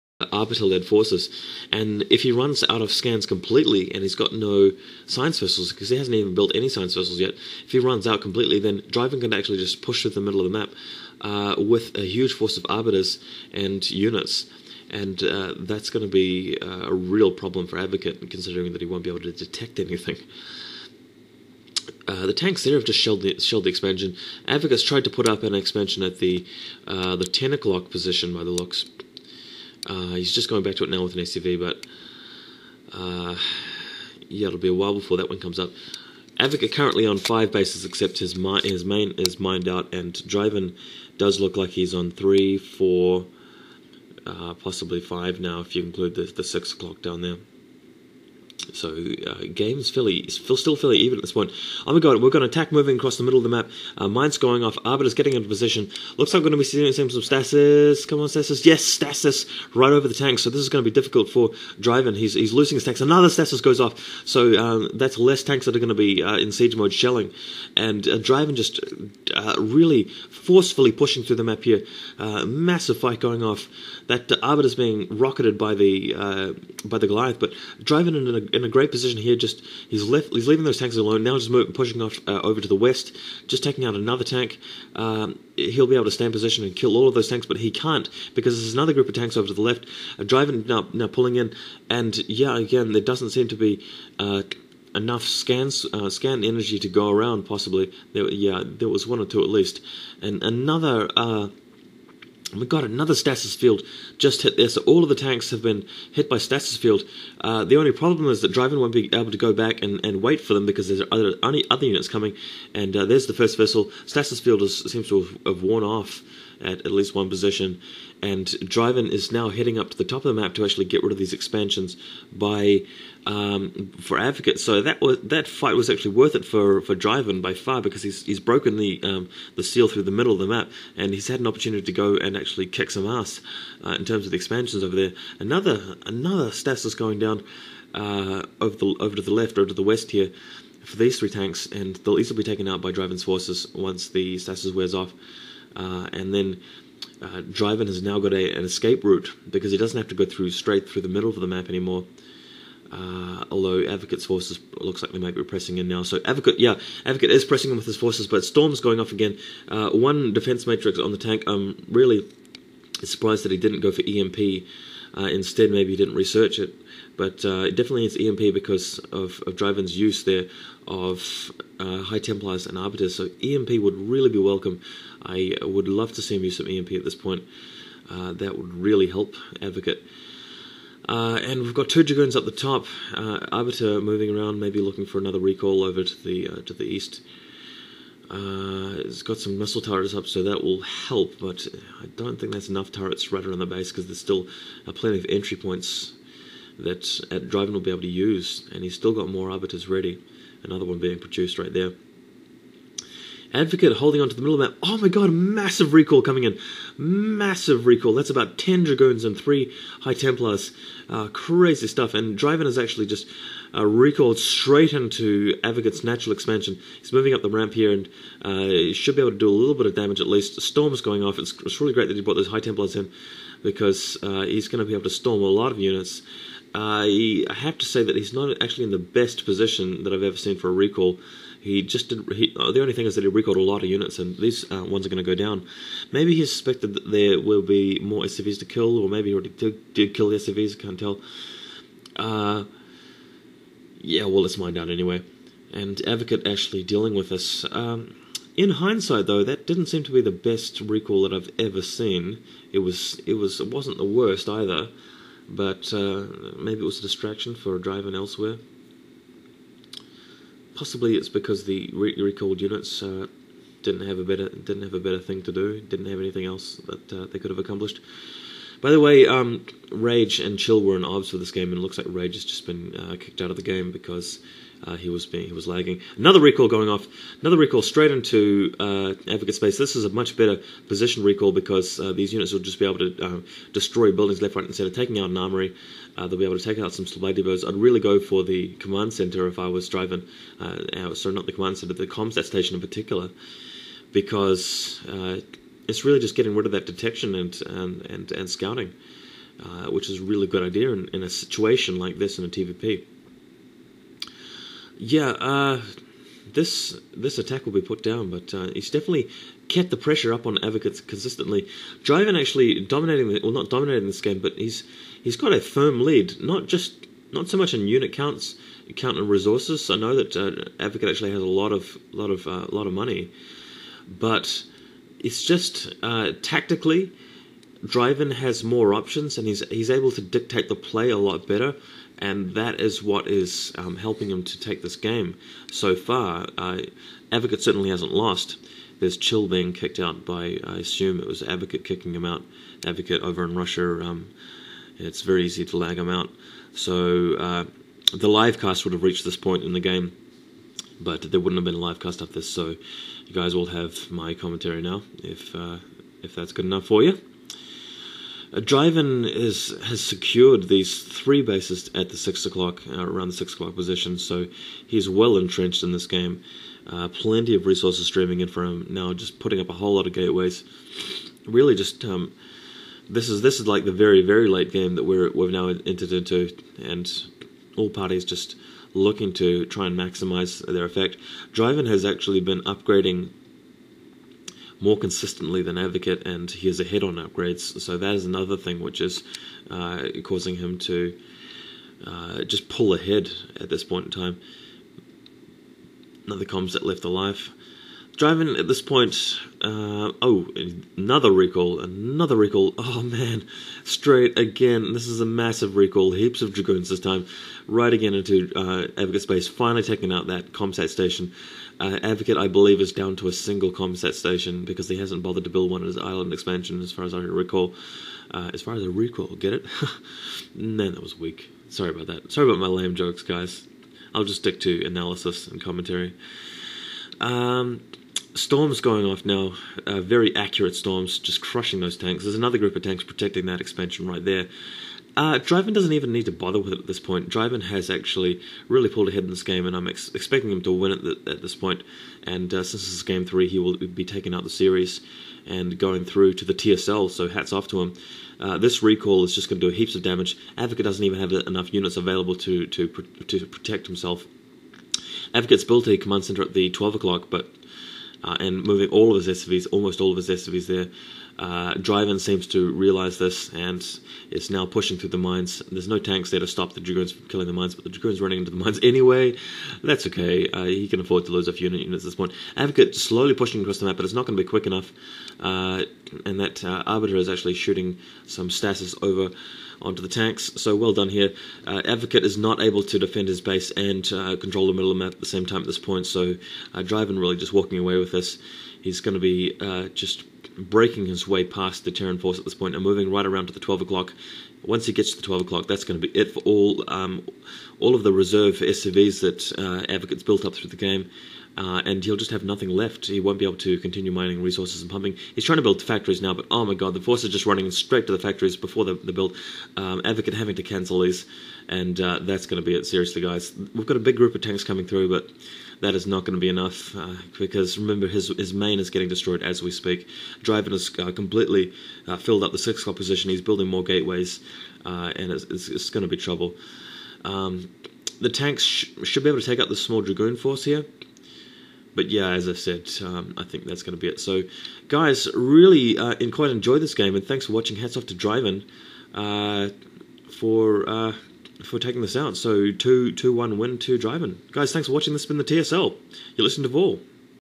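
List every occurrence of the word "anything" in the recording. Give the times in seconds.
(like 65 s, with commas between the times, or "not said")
19 s, 266 s.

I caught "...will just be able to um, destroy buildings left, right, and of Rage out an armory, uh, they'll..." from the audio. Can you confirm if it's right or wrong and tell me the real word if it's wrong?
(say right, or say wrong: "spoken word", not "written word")
wrong: "Taking", not "Rage".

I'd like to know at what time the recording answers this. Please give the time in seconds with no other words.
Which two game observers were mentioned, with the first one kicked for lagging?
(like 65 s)
269 s.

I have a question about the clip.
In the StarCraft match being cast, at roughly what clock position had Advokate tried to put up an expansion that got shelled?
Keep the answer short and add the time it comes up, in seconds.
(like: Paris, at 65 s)
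10 o'clock, at 27 s.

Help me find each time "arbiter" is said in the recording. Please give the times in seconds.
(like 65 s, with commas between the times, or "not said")
0 s, 12 s, 54 s, 74 s, 172 s, 183 s, 199 s, 476 s.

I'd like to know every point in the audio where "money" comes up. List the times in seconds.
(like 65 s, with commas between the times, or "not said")
322 s.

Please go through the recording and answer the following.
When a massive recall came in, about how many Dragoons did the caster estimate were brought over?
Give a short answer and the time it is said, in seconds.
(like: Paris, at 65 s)
10, at 208 s.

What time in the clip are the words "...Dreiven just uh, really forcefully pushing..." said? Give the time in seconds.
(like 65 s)
68 s.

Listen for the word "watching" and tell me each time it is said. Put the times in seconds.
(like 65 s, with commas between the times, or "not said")
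537 s, 544 s.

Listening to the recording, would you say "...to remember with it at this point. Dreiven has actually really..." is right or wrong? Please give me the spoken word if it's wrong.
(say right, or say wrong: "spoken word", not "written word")
wrong: "bother", not "remember".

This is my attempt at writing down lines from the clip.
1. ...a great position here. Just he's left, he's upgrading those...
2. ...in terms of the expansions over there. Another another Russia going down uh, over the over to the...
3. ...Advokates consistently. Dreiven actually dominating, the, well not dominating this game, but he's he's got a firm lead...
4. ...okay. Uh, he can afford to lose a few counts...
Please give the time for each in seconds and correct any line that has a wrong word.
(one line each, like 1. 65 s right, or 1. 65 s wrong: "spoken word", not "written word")
1. 78 s wrong: "leaving", not "upgrading"
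2. 133 s wrong: "Stasis", not "Russia"
3. 310 s right
4. 470 s wrong: "units", not "counts".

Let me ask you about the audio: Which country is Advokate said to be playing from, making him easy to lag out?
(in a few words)
Russia.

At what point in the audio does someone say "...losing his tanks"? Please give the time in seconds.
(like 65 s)
62 s.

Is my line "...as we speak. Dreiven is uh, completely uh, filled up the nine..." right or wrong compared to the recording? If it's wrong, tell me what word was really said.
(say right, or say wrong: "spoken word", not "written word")
wrong: "six", not "nine".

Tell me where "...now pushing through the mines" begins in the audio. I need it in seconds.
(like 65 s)
464 s.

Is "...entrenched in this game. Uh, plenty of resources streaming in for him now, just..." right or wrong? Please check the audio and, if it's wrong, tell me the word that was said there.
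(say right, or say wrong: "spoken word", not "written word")
right.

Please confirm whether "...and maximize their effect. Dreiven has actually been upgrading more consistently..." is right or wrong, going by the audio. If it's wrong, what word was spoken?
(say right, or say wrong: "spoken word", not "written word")
right.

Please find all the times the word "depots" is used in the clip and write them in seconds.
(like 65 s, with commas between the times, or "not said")
287 s.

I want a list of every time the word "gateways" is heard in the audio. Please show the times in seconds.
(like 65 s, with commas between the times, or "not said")
370 s, 523 s.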